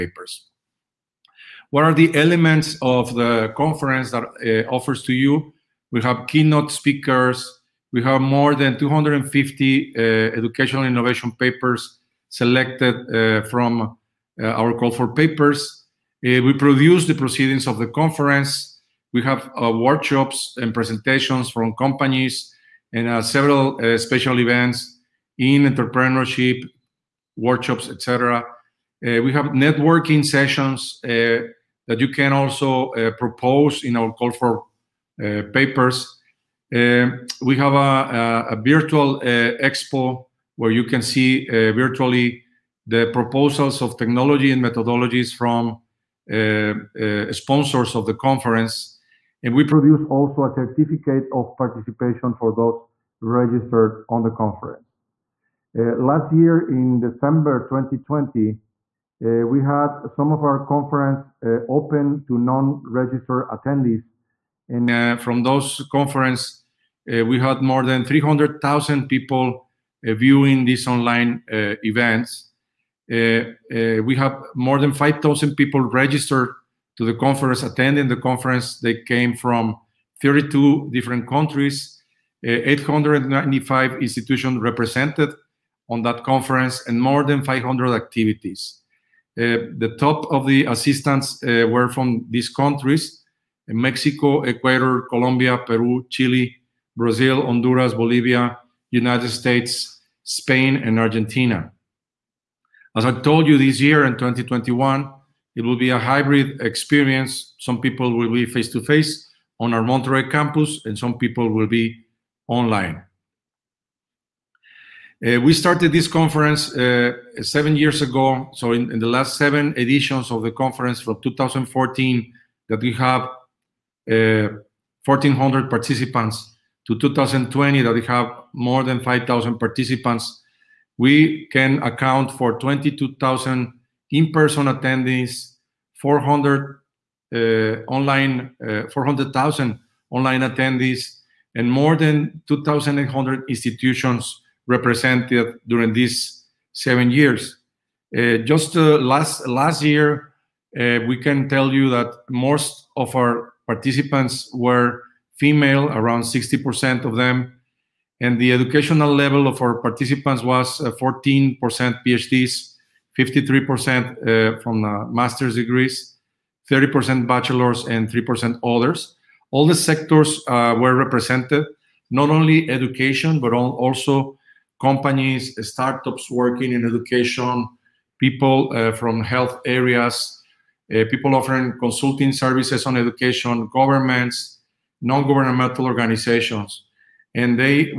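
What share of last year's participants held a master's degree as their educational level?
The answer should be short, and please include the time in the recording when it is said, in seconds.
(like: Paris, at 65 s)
53%, at 163 s.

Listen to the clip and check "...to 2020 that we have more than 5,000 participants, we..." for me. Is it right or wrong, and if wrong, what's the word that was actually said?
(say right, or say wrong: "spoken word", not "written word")
right.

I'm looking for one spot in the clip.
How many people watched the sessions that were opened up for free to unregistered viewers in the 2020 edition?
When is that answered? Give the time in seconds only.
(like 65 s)
67 s.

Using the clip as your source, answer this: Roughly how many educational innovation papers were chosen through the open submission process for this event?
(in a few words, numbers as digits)
more than 250.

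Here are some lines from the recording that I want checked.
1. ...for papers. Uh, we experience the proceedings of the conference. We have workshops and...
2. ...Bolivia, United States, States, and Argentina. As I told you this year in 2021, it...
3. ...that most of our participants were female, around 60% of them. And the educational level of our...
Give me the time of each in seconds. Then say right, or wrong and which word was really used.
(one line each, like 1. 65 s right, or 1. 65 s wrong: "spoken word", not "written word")
1. 14 s wrong: "produce", not "experience"
2. 97 s wrong: "Spain", not "States"
3. 151 s right.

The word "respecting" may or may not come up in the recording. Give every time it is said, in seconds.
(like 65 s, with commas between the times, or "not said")
not said.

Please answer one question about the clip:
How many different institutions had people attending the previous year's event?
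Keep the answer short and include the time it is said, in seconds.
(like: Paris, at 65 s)
895, at 82 s.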